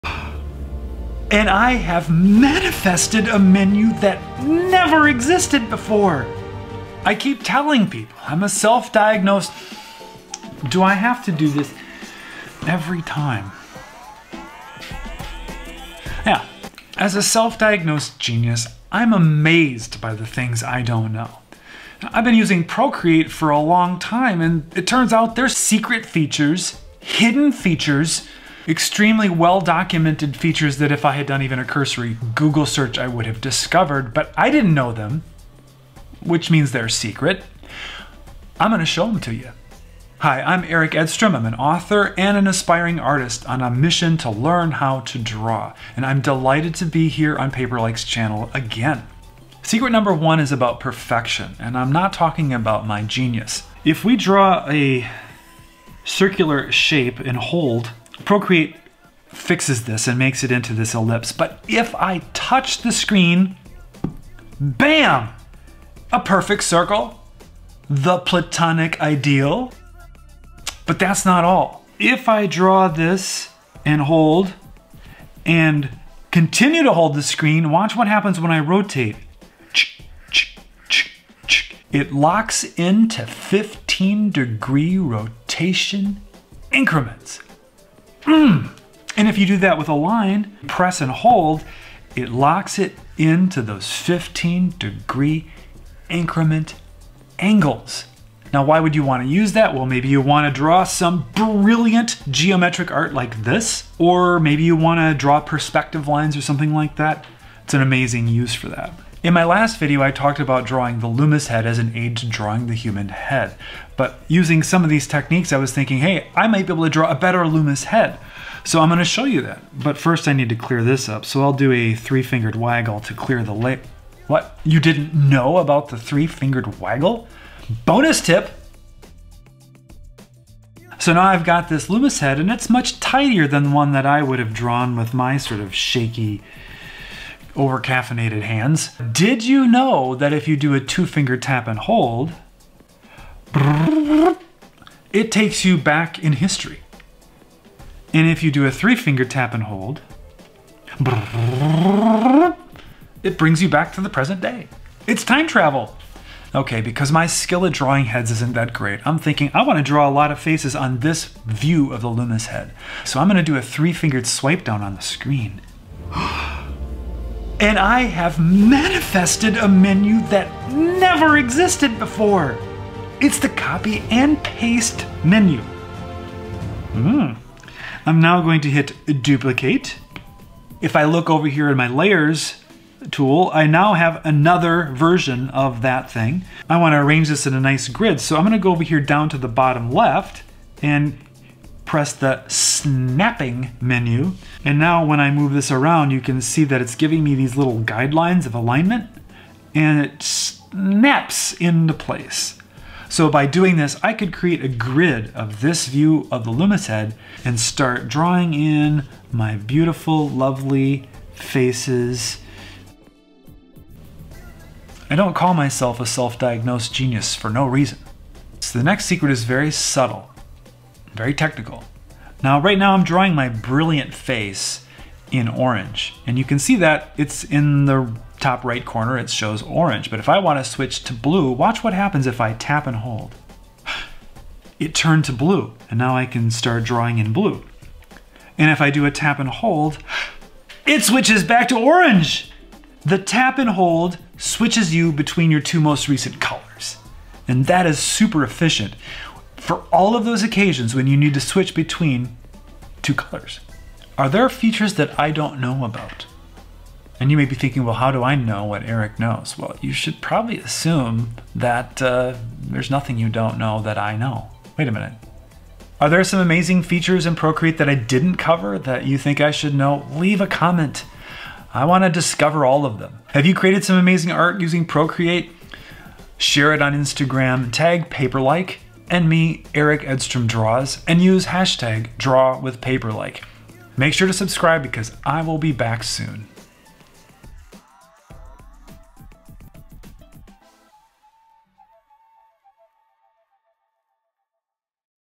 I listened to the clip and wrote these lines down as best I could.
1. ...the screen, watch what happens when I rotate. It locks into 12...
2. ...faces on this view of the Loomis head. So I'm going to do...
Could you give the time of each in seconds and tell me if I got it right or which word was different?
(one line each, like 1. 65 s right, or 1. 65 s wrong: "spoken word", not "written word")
1. 77 s wrong: "15", not "12"
2. 160 s right.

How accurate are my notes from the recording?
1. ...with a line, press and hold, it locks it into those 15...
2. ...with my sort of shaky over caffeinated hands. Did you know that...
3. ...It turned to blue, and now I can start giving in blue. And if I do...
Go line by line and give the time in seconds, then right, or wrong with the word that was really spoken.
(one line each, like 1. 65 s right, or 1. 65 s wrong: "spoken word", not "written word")
1. 89 s right
2. 134 s right
3. 234 s wrong: "drawing", not "giving".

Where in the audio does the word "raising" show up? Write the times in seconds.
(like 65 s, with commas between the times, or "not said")
not said.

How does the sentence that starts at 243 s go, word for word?
The tap and hold switches you between your two most recent colors.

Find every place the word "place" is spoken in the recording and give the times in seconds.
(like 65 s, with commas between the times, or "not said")
201 s.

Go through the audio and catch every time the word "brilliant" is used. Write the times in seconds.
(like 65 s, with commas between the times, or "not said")
101 s, 223 s.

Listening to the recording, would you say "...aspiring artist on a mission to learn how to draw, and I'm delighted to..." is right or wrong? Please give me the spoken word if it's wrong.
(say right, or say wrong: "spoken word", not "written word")
right.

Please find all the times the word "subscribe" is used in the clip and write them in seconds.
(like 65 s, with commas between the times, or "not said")
284 s.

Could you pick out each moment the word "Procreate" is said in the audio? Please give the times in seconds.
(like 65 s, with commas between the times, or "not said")
22 s, 58 s, 267 s, 274 s.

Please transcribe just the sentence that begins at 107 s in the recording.
It's an amazing use for that.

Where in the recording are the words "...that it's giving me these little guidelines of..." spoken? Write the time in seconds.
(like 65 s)
196 s.